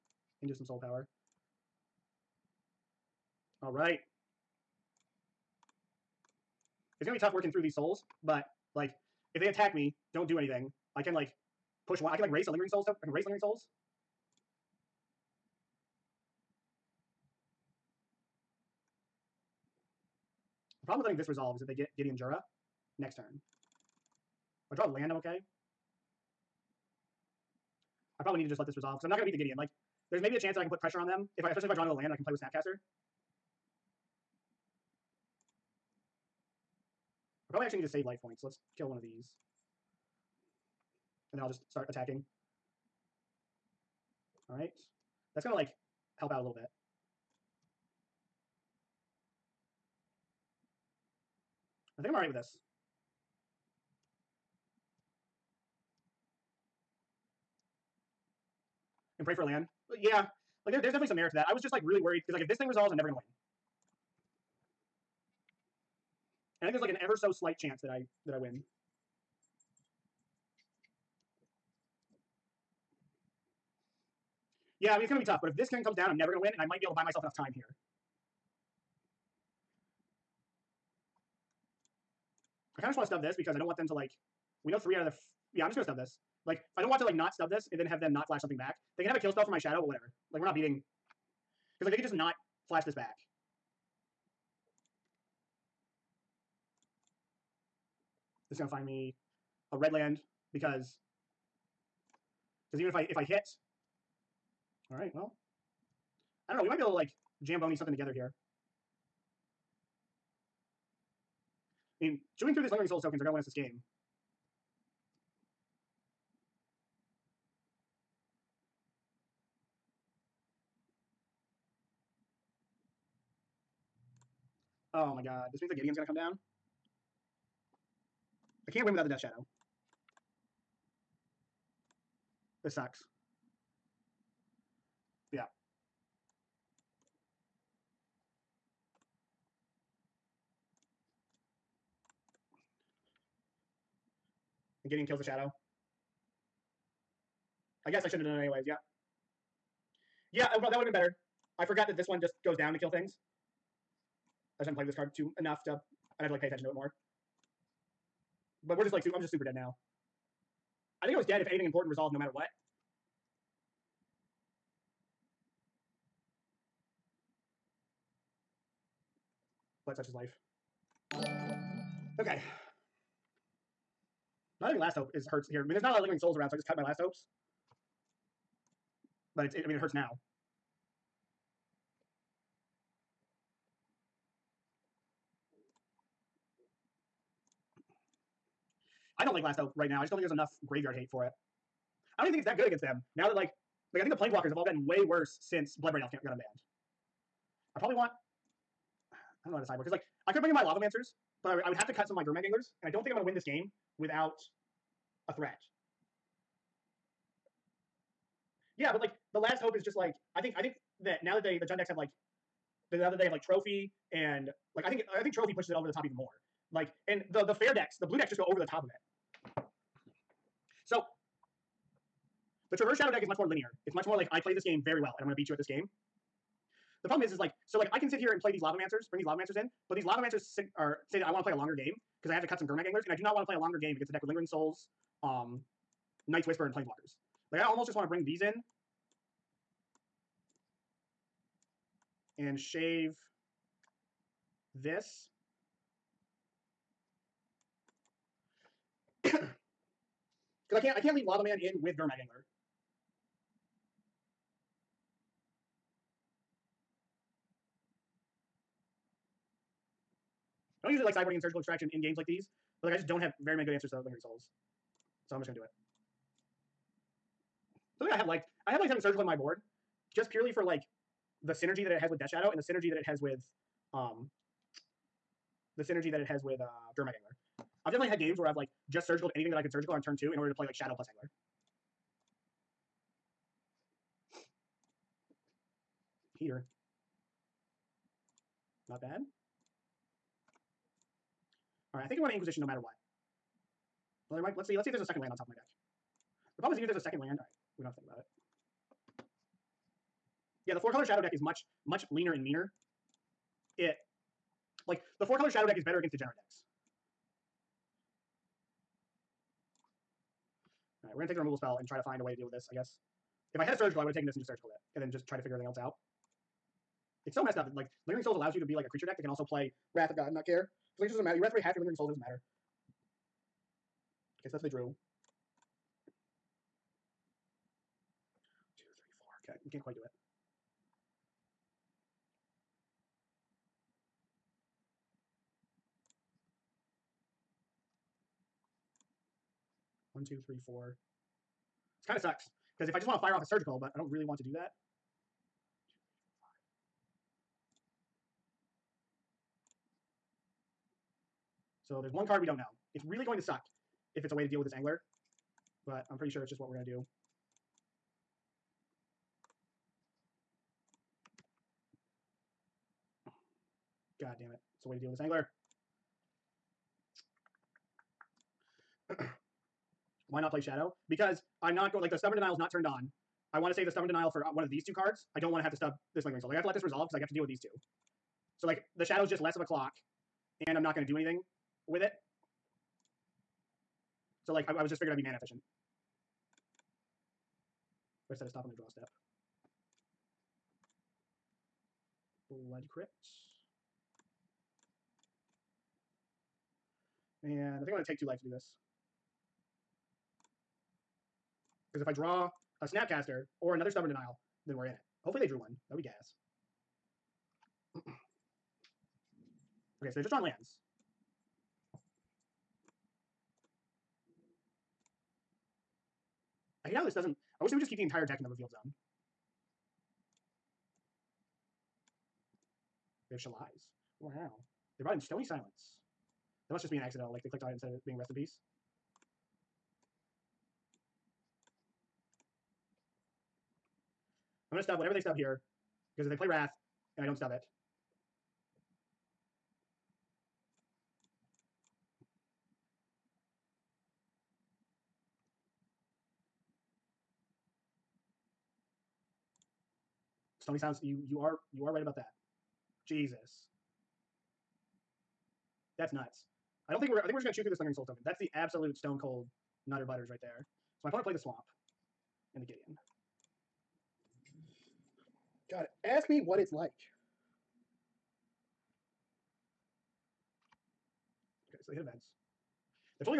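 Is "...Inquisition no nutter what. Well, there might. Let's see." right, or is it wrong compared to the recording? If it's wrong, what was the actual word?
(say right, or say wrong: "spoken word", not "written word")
wrong: "matter", not "nutter".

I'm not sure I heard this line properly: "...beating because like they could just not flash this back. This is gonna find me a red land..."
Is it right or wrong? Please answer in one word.
right.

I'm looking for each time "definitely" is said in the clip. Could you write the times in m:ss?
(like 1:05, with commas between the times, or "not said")
1:00, 4:37.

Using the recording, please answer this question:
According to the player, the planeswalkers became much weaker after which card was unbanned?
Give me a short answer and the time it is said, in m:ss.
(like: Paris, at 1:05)
Bloodbraid Elf, at 3:15.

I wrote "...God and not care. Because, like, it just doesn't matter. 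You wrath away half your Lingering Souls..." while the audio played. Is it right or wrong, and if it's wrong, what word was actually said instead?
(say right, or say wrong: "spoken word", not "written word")
right.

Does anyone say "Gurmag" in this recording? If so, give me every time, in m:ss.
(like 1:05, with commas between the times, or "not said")
3:22, 3:52, 4:11.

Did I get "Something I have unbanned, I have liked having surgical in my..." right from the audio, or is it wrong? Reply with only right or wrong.
wrong.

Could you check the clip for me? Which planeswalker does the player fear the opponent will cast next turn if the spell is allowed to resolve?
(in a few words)
Gideon Jura.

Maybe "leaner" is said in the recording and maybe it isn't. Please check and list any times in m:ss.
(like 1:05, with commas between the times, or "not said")
5:02.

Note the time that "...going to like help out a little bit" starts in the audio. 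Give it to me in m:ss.
0:45.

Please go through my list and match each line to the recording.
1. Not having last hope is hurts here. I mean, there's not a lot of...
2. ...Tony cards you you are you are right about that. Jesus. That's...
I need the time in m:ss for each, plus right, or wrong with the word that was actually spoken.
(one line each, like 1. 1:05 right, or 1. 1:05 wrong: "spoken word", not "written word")
1. 2:54 right
2. 7:30 wrong: "sounds", not "cards".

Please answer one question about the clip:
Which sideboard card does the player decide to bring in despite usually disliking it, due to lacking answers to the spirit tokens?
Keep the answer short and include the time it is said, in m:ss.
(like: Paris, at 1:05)
Surgical Extraction, at 4:21.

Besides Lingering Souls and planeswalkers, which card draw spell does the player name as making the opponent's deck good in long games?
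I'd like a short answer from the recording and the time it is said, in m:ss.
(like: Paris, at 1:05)
Night's Whisper, at 3:56.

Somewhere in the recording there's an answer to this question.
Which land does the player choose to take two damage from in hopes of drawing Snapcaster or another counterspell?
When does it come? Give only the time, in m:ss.
6:32.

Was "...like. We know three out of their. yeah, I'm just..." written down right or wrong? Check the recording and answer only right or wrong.
right.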